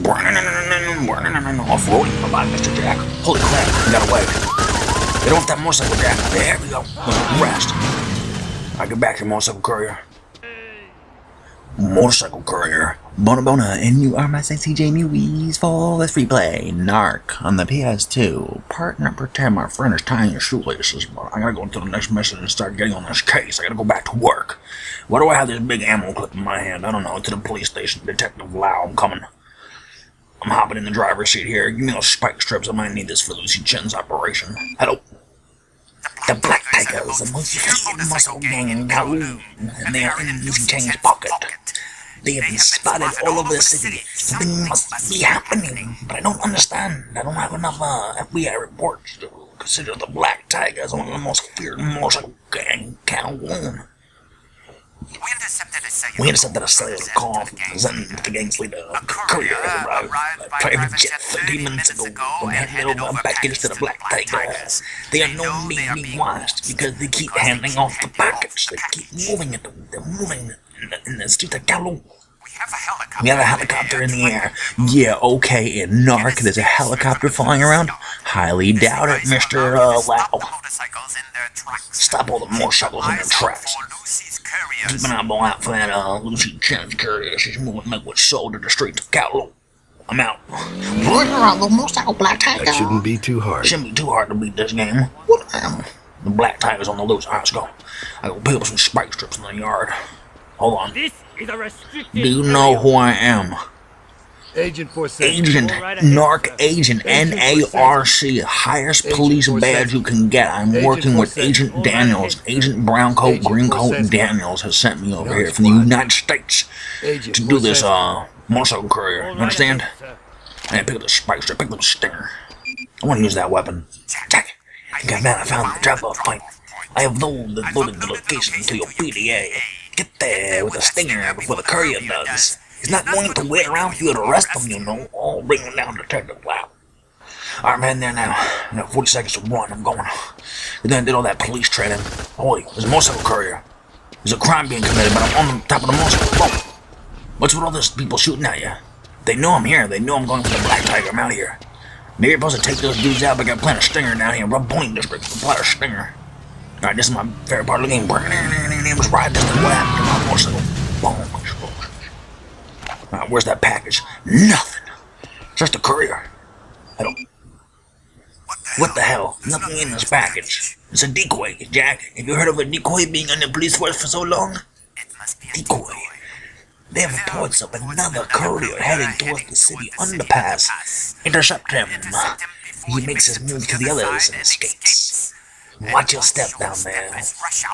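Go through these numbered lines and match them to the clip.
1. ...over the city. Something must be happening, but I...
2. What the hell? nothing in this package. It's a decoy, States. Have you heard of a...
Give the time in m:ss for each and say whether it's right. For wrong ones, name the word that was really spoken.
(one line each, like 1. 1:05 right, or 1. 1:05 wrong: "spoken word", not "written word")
1. 0:43 right
2. 2:48 wrong: "Jack", not "States".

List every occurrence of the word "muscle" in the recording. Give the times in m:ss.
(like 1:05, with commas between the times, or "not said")
0:38, 0:51, 1:58.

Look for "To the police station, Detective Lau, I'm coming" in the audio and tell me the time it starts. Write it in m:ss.
0:27.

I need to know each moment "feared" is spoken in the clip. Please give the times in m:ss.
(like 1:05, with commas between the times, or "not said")
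0:37, 0:51.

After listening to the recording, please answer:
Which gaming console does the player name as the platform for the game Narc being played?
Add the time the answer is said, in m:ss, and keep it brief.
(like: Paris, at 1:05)
PS2, at 0:17.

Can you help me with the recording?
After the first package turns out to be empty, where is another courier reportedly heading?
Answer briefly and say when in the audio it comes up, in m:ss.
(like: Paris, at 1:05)
City underpass, at 2:59.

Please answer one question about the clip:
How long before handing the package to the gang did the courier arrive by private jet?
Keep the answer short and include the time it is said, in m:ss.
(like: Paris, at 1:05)
30 minutes, at 1:01.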